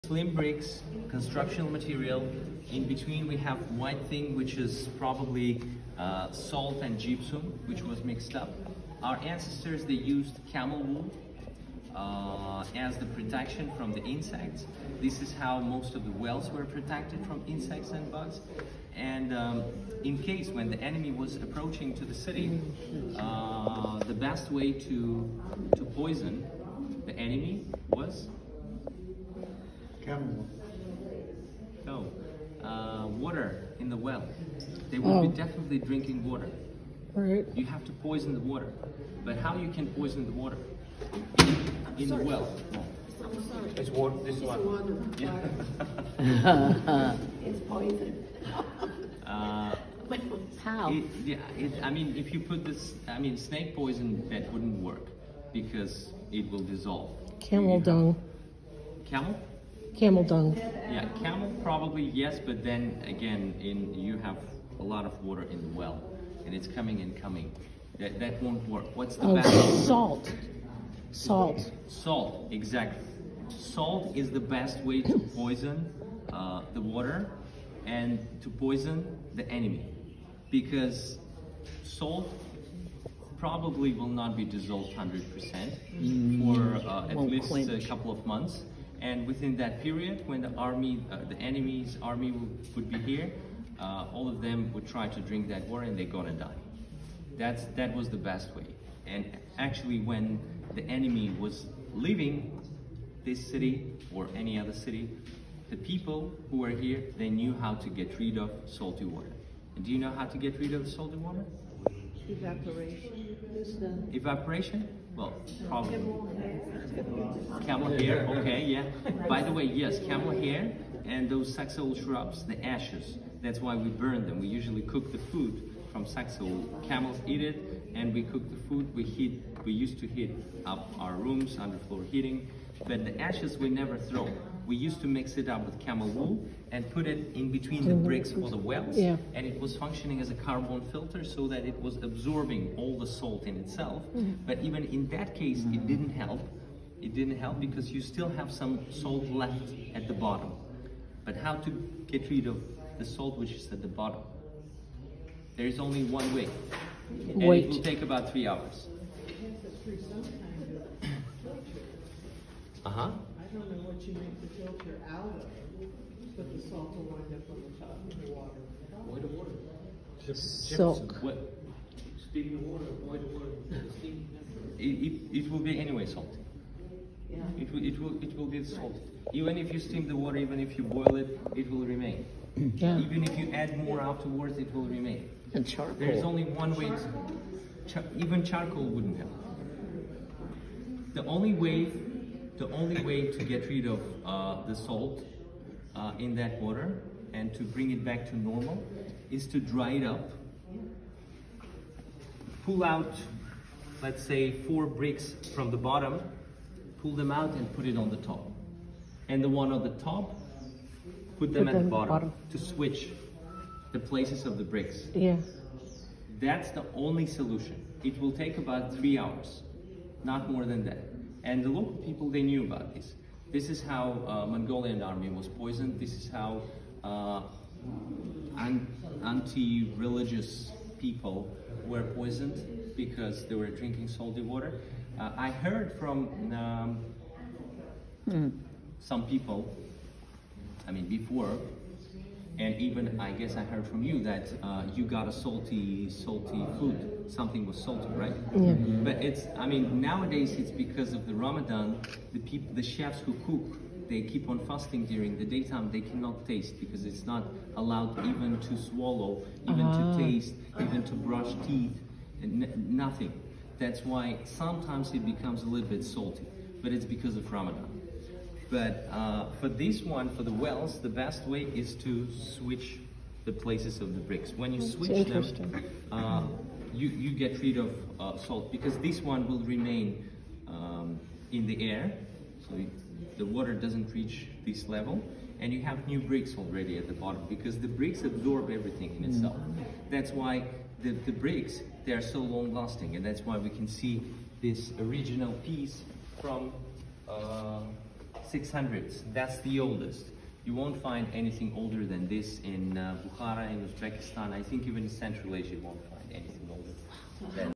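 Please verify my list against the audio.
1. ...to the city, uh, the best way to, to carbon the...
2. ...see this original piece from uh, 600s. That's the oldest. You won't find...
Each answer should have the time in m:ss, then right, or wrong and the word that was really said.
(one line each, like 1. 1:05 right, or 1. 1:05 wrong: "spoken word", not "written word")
1. 0:21 wrong: "poison", not "carbon"
2. 4:53 right.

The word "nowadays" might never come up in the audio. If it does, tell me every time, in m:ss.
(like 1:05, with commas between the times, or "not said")
4:09.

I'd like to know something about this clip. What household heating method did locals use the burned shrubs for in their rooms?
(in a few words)
underfloor heating.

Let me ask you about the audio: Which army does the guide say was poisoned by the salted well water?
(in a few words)
Mongolian army.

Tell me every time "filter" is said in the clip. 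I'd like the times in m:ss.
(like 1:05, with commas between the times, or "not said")
2:20, 2:44.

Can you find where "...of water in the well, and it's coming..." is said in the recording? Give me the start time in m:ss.
1:05.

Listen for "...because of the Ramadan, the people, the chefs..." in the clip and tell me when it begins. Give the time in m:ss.
4:10.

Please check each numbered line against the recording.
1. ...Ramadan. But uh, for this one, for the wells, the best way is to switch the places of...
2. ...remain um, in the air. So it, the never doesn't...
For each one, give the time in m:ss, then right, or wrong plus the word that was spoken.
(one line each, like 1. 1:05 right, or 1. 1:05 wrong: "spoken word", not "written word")
1. 4:27 right
2. 4:39 wrong: "water", not "never".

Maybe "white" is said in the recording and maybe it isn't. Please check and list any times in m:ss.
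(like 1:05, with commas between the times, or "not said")
0:03.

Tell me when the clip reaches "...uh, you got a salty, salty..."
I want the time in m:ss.
4:04.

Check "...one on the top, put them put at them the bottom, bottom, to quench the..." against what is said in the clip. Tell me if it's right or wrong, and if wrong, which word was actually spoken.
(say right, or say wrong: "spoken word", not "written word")
wrong: "switch", not "quench".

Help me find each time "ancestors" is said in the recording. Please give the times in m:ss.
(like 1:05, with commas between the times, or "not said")
0:09.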